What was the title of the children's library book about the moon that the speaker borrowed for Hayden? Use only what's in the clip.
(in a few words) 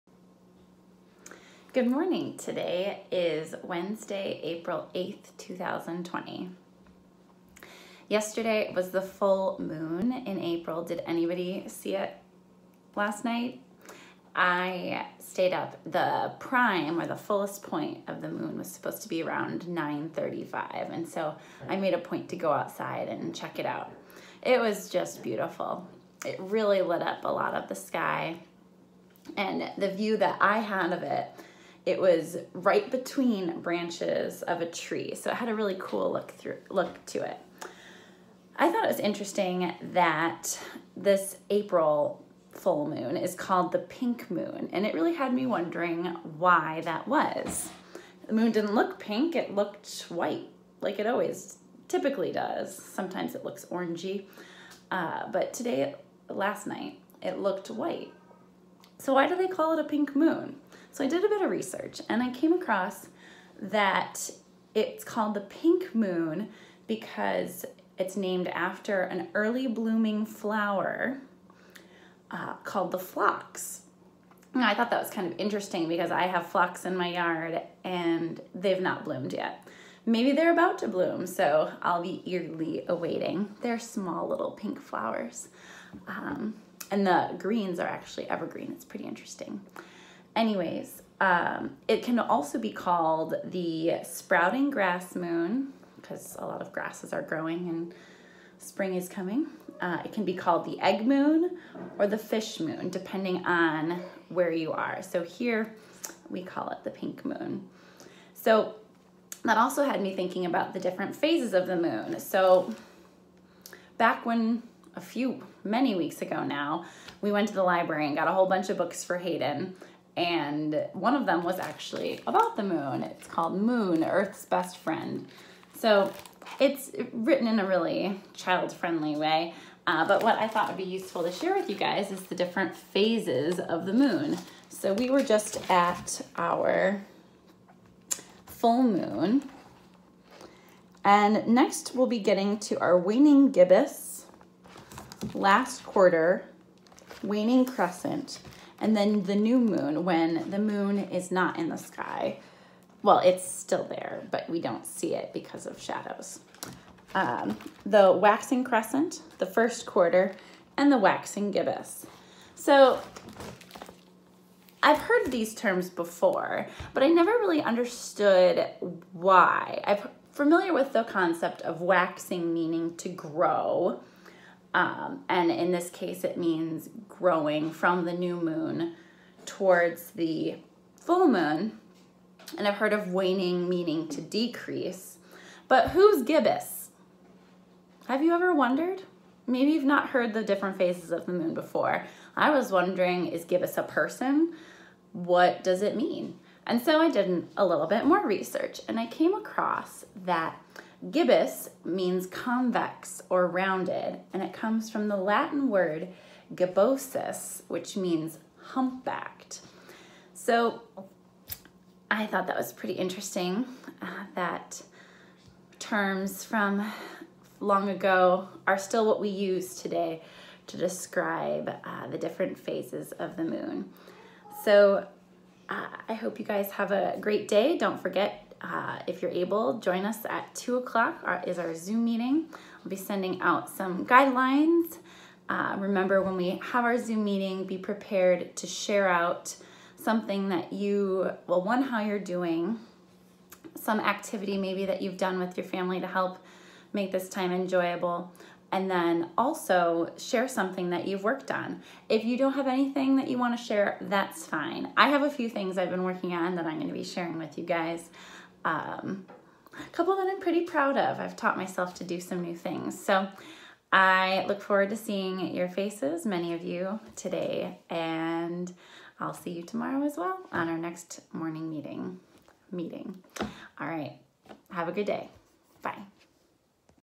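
Moon, Earth's Best Friend.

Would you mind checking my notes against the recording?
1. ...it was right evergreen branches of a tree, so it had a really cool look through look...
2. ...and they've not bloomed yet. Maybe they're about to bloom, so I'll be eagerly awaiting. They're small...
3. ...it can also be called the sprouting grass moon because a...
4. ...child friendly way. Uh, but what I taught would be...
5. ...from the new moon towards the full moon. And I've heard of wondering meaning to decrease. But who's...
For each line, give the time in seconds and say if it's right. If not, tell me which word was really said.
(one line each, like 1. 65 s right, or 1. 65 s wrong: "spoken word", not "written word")
1. 31 s wrong: "between", not "evergreen"
2. 77 s right
3. 91 s right
4. 128 s wrong: "thought", not "taught"
5. 177 s wrong: "waning", not "wondering".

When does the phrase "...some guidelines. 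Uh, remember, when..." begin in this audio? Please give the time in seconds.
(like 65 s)
233 s.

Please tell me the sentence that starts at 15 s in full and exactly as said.
The prime or the fullest point of the moon was supposed to be around 9.35.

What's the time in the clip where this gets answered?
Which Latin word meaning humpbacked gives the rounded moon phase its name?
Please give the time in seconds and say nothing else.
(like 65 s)
206 s.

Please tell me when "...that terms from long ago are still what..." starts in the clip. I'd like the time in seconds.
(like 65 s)
214 s.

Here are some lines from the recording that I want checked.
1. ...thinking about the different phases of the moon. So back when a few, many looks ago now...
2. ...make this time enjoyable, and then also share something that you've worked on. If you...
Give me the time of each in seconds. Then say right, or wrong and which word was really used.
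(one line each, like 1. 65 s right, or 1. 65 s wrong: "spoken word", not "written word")
1. 110 s wrong: "weeks", not "looks"
2. 246 s right.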